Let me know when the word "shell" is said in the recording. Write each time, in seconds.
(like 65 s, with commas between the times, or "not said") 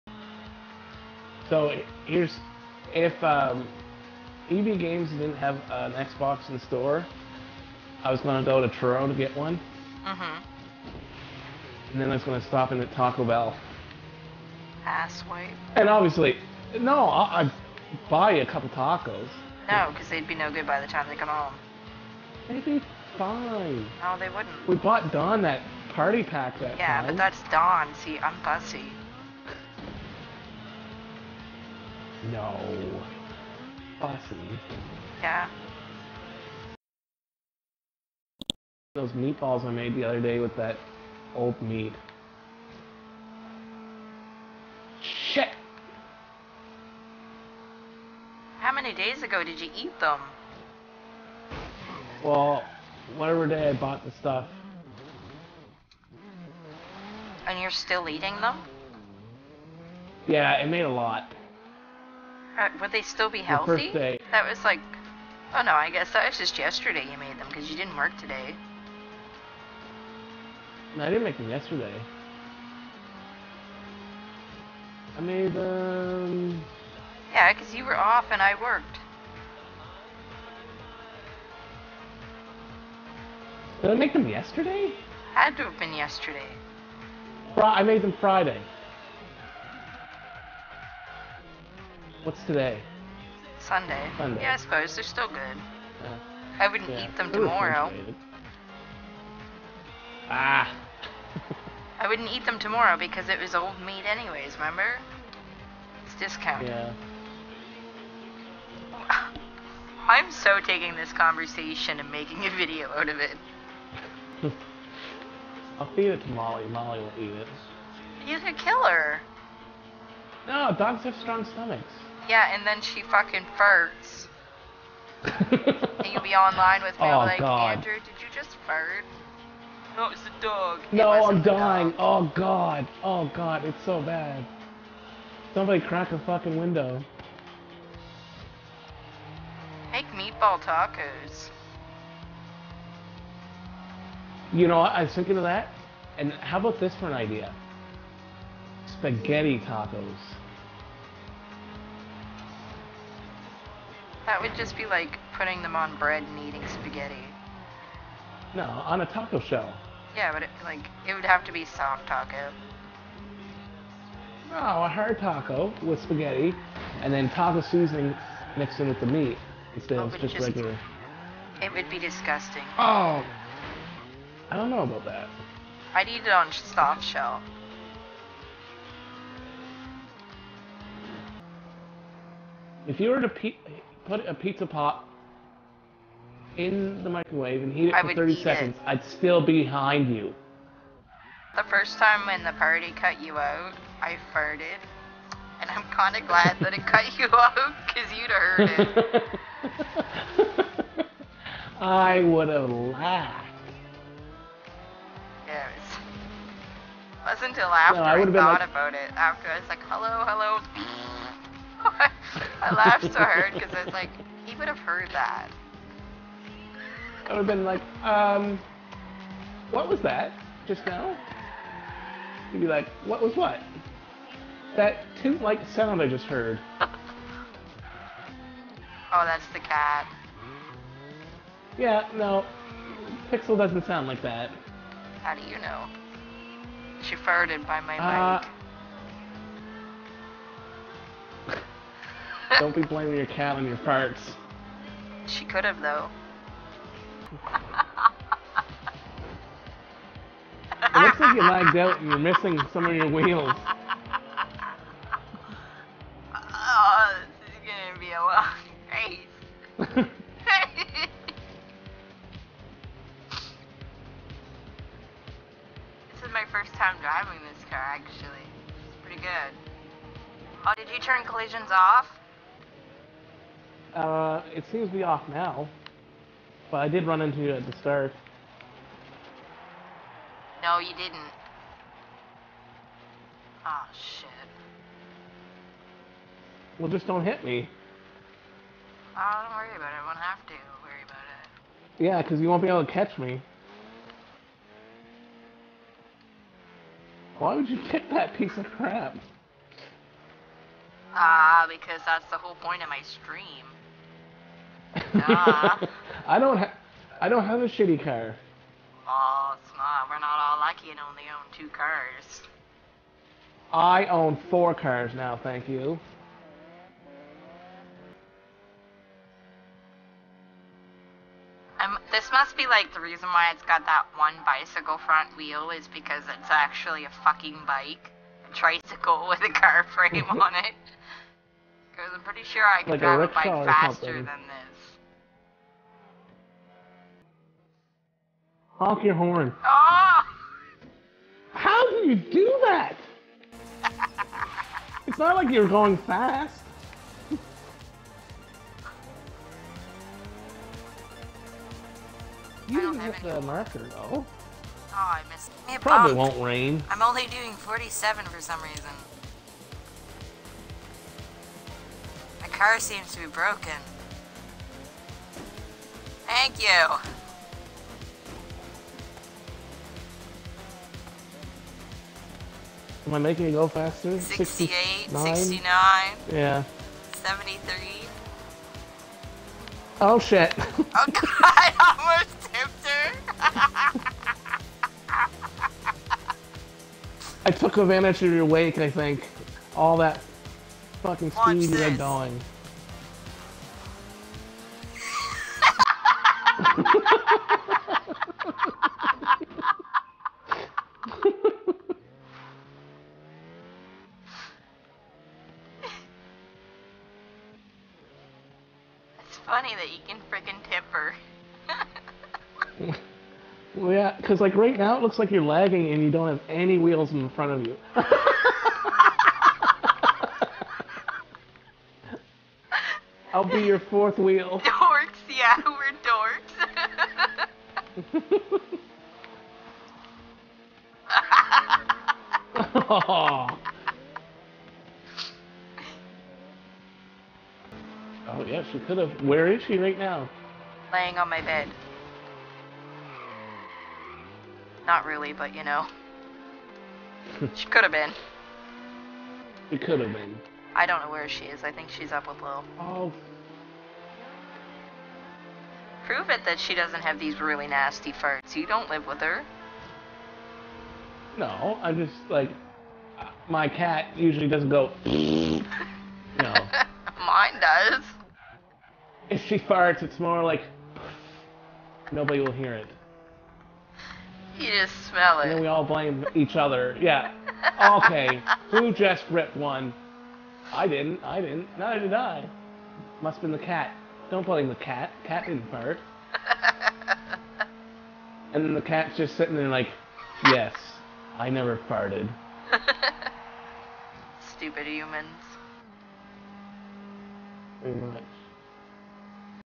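159 s, 177 s.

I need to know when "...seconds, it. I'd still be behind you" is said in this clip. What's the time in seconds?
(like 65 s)
188 s.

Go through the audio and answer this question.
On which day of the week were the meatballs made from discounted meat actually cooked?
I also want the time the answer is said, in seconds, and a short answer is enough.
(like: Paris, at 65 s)
Friday, at 88 s.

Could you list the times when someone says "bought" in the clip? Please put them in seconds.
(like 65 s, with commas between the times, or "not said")
24 s, 53 s.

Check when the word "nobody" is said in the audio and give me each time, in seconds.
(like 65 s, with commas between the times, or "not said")
472 s.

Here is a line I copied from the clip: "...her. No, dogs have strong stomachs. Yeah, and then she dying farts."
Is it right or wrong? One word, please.
wrong.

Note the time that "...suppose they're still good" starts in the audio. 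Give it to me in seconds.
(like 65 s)
94 s.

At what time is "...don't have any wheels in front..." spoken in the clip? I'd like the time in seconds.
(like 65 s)
416 s.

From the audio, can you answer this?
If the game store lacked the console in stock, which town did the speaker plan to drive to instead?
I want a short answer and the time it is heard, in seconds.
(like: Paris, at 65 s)
Truro, at 8 s.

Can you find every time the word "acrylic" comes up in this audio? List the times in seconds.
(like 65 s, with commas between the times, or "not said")
not said.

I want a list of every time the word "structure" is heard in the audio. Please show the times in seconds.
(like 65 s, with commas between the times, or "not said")
not said.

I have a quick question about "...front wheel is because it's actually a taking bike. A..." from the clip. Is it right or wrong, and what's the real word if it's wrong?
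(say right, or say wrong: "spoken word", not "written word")
wrong: "fucking", not "taking".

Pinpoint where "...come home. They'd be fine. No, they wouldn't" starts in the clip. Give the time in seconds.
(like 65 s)
21 s.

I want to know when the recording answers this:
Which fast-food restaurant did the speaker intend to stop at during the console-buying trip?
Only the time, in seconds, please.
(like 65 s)
12 s.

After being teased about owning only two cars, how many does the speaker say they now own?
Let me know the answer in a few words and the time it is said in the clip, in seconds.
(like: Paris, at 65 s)
4, at 314 s.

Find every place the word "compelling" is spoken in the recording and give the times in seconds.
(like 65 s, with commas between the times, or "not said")
not said.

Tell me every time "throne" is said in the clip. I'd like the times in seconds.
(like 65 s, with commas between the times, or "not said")
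not said.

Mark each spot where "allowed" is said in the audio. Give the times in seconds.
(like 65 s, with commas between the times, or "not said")
not said.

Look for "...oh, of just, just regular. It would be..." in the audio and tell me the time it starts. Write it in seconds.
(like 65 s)
169 s.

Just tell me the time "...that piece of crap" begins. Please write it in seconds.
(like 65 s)
298 s.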